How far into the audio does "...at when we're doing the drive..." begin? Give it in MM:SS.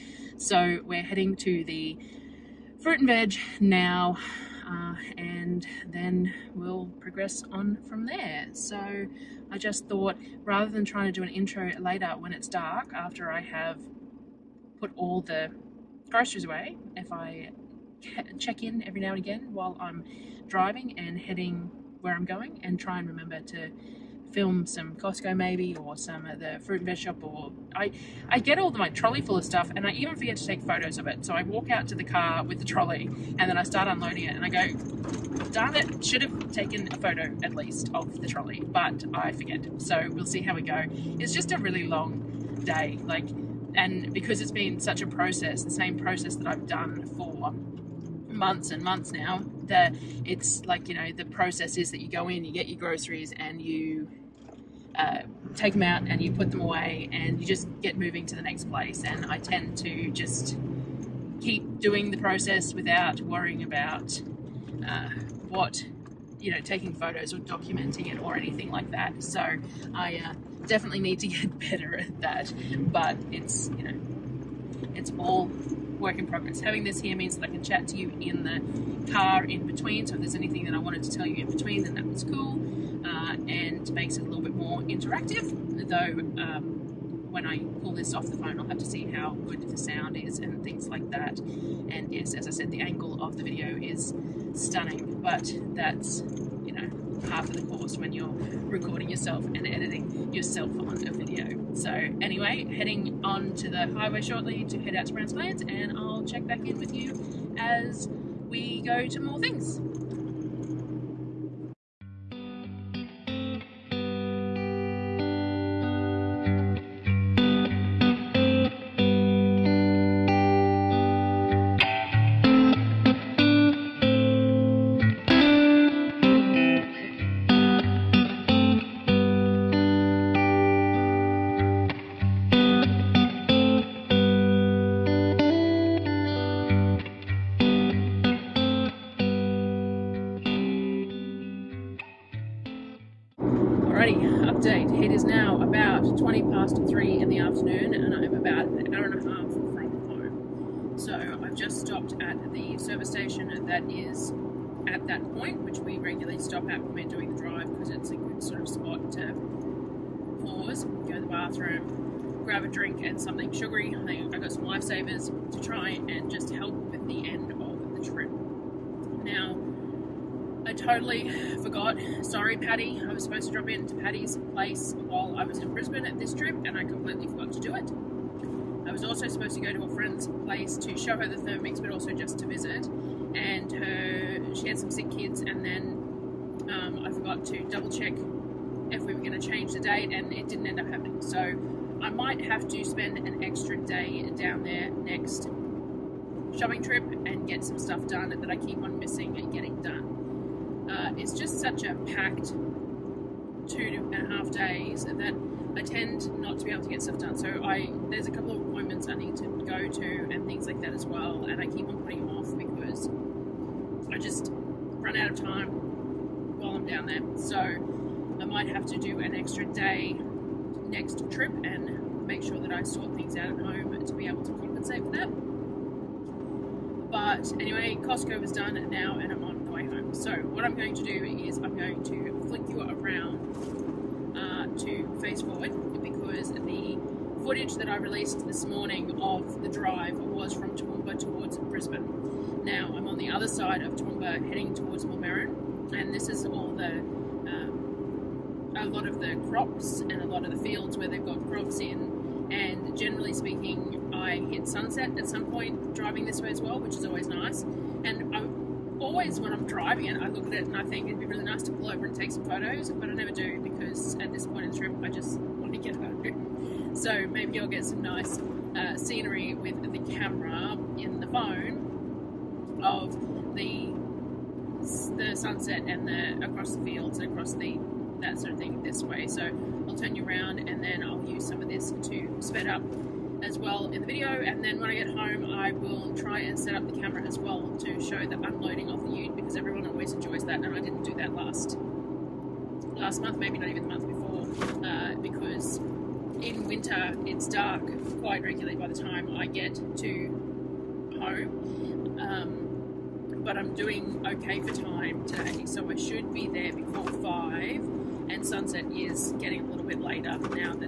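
02:36.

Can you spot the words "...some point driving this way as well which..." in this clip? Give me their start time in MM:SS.
04:15.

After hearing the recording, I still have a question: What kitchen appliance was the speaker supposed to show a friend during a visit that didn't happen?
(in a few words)
Thermix.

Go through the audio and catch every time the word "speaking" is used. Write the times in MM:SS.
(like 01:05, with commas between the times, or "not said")
04:13.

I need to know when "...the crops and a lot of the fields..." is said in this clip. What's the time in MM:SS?
04:09.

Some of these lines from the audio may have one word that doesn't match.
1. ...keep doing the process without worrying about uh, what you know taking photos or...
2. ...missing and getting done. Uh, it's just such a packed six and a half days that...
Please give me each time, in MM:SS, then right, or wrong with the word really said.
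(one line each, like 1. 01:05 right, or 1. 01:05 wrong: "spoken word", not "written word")
1. 01:01 right
2. 03:18 wrong: "two", not "six".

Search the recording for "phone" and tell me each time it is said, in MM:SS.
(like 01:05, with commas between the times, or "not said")
01:28, 04:31.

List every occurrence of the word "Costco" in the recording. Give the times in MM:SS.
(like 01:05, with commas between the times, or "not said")
00:24, 03:48.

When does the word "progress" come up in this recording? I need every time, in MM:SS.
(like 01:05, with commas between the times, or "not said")
00:06, 01:16.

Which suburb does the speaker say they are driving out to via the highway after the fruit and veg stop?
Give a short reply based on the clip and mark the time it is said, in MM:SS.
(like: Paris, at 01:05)
Browns Plains, at 01:45.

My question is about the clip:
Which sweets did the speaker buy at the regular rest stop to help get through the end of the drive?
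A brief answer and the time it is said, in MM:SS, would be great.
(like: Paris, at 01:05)
Lifesavers, at 02:44.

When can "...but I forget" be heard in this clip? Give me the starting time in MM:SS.
00:38.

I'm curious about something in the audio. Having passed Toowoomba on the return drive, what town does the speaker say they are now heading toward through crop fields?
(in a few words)
Millmerran.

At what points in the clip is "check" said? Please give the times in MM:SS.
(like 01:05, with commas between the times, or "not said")
00:18, 01:46, 03:07.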